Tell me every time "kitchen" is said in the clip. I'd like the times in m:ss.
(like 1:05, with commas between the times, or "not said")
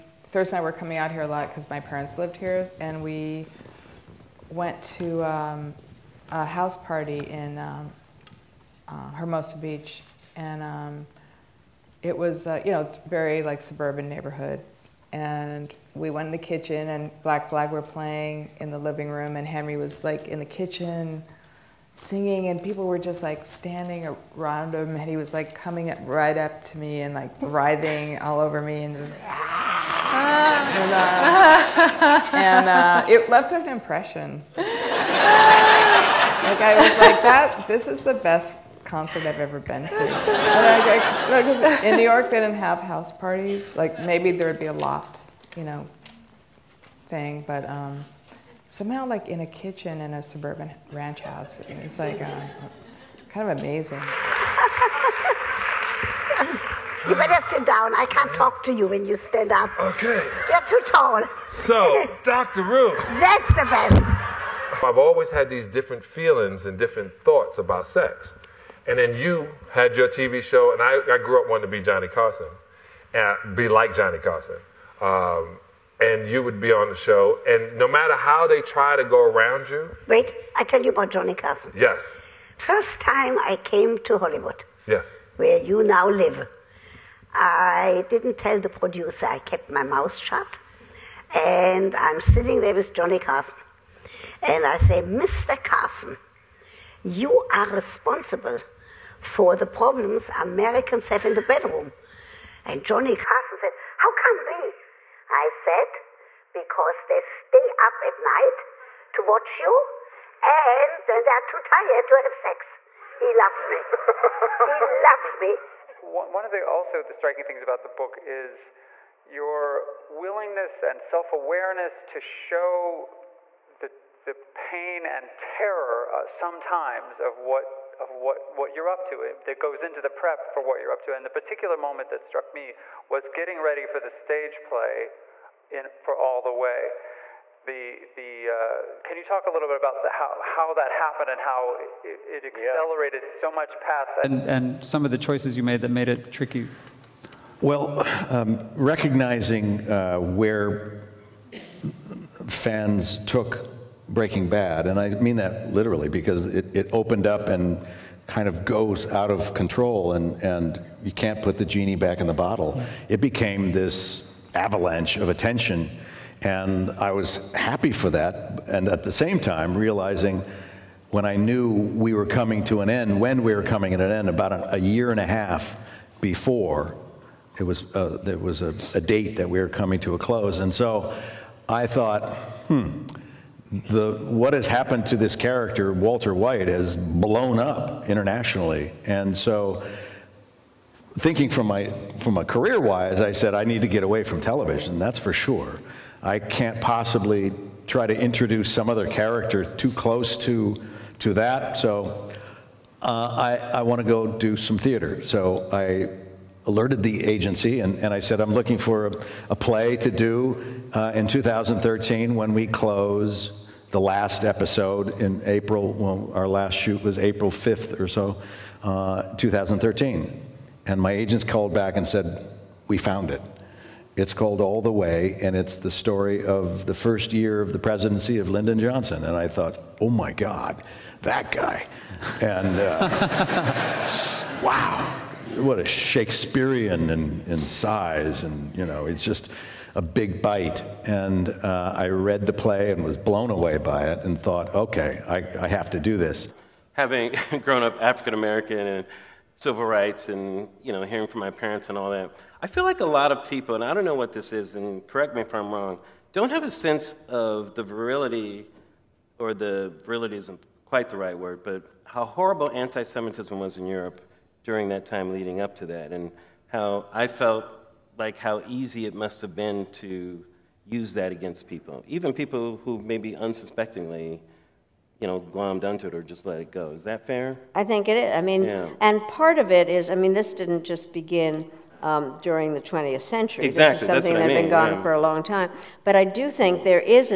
0:16, 0:20, 0:49.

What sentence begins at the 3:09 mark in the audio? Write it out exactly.
And so, thinking from my, from a career wise, I said, I need to get away from television, that's for sure.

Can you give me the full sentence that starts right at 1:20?
Wait, I tell you about Johnny Carson.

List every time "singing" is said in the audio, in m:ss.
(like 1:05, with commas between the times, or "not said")
0:21.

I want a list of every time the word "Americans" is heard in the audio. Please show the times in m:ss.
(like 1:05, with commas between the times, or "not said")
1:40, 4:08.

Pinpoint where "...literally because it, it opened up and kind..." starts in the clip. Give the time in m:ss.
2:35.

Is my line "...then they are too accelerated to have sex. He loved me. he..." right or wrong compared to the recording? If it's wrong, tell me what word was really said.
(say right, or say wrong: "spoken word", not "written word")
wrong: "tired", not "accelerated".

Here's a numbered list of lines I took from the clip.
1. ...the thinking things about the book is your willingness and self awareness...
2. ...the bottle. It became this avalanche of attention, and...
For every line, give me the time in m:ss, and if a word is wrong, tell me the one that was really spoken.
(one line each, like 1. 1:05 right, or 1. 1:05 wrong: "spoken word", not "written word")
1. 1:57 wrong: "striking", not "thinking"
2. 2:42 right.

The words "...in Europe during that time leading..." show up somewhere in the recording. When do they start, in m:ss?
4:23.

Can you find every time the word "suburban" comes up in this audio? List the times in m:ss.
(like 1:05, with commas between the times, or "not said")
0:13, 0:50.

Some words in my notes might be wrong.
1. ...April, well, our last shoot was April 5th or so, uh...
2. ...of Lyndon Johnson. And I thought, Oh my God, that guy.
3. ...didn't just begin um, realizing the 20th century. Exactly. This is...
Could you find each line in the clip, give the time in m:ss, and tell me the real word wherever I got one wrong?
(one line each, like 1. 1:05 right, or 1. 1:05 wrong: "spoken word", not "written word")
1. 3:35 right
2. 3:48 right
3. 4:40 wrong: "during", not "realizing".